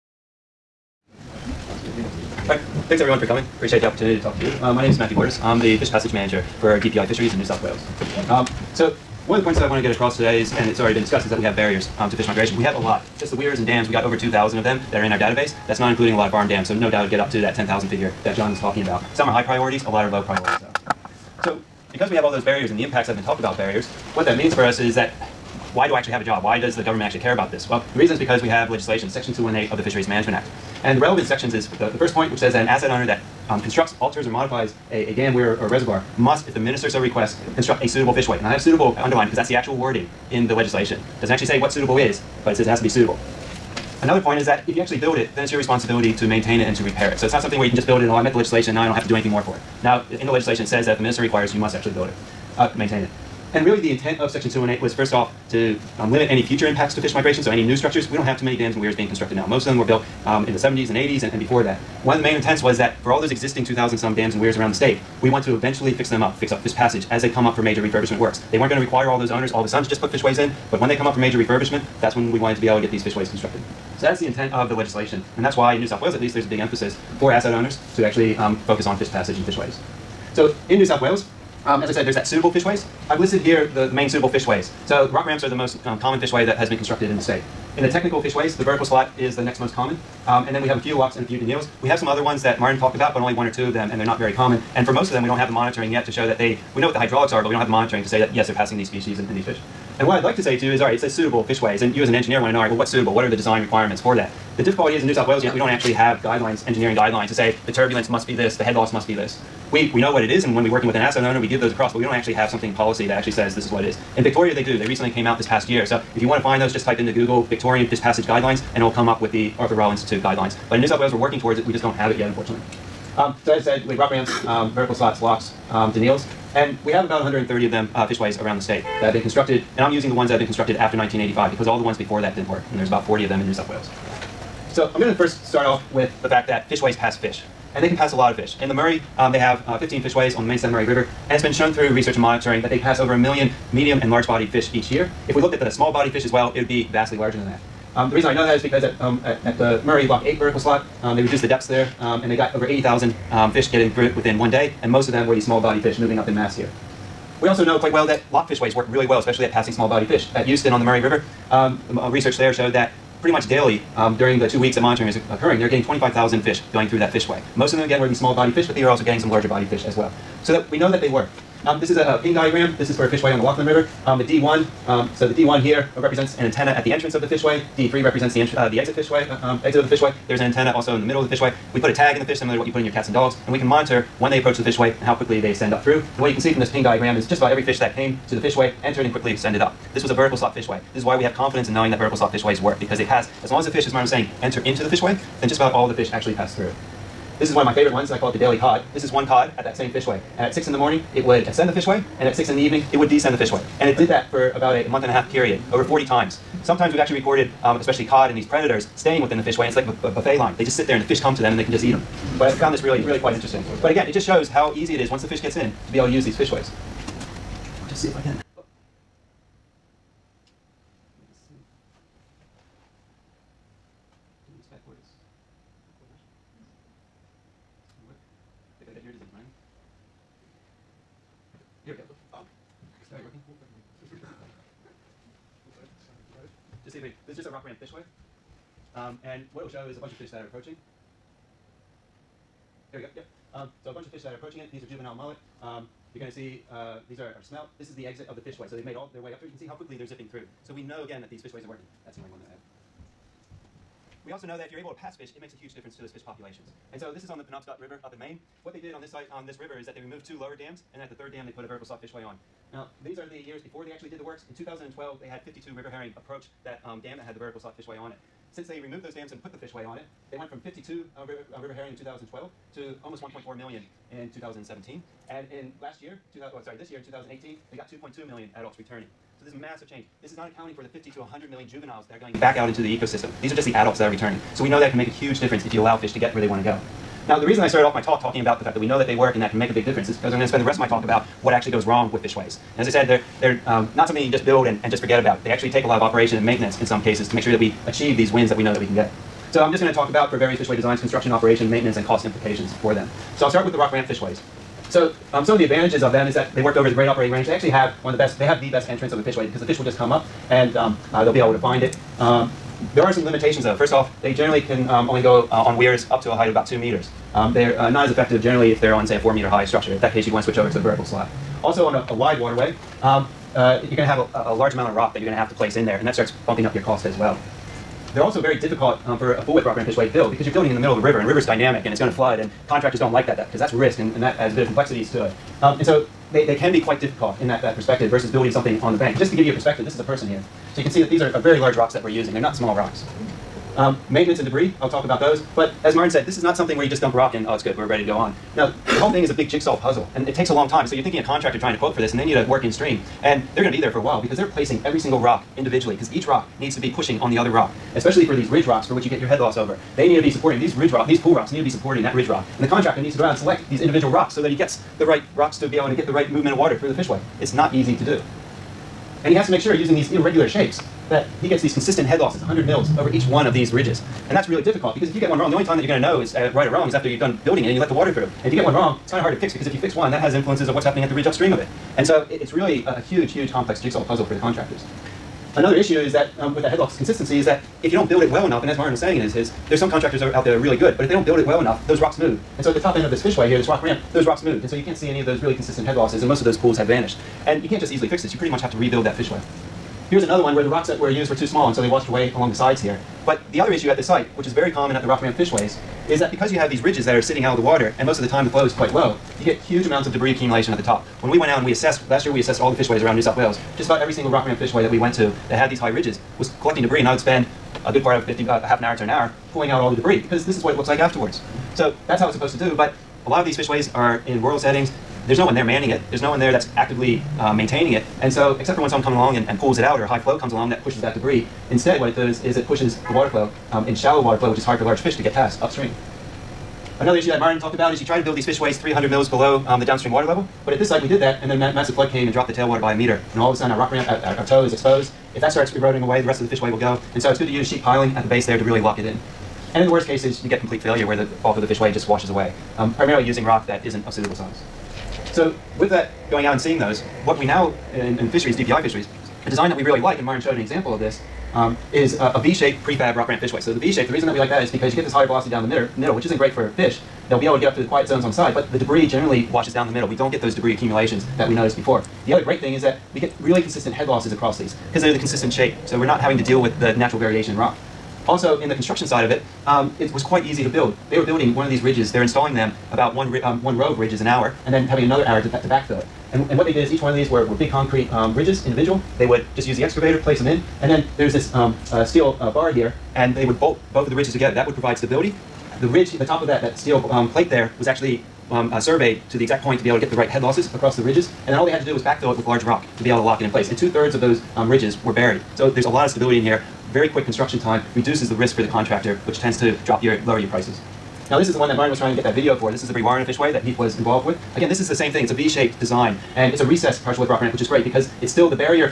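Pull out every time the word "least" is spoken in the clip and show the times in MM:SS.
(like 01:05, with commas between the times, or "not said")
01:16.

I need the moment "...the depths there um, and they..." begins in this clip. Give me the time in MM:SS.
02:31.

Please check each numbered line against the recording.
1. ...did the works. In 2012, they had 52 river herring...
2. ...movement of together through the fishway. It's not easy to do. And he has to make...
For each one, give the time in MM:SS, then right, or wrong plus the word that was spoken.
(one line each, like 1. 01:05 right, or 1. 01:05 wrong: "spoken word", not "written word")
1. 04:24 right
2. 06:06 wrong: "water", not "together".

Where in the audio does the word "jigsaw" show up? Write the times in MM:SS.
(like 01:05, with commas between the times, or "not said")
05:49, 06:23.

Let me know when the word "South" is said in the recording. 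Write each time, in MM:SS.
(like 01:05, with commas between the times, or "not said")
00:07, 01:15, 01:20, 01:45, 02:00, 02:13, 06:53.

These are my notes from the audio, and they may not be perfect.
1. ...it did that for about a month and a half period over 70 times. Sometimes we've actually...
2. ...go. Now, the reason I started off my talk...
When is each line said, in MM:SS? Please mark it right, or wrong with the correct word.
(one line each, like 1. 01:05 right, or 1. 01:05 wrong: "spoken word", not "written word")
1. 03:23 wrong: "40", not "70"
2. 04:46 right.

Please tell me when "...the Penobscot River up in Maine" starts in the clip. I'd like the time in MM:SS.
04:17.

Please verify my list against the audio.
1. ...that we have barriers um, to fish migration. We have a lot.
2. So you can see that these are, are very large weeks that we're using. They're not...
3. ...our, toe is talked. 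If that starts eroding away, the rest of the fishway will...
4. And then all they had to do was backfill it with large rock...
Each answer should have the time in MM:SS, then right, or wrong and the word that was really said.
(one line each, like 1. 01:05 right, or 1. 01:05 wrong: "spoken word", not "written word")
1. 00:11 right
2. 05:40 wrong: "rocks", not "weeks"
3. 07:24 wrong: "exposed", not "talked"
4. 08:21 right.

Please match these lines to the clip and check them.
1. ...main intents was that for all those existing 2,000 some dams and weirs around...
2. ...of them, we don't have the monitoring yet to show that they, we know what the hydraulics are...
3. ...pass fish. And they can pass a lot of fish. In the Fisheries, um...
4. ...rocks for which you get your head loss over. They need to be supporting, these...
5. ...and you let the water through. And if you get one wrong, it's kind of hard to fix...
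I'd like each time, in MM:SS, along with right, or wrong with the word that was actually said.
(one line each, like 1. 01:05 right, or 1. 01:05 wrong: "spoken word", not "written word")
1. 01:02 right
2. 01:35 right
3. 02:16 wrong: "Murray", not "Fisheries"
4. 05:58 right
5. 06:17 right.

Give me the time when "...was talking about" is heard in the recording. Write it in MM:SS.
00:18.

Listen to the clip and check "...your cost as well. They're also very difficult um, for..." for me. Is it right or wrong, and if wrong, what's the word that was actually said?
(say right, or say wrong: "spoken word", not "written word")
right.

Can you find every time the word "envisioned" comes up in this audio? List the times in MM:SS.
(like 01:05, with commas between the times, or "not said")
not said.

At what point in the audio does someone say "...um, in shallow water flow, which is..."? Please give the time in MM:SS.
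07:13.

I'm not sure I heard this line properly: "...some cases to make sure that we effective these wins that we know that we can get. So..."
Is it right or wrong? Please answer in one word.
wrong.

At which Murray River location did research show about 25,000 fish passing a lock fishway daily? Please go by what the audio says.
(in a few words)
Euston.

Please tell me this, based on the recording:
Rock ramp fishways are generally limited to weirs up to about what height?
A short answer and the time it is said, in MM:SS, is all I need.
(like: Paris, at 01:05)
2 meters, at 05:16.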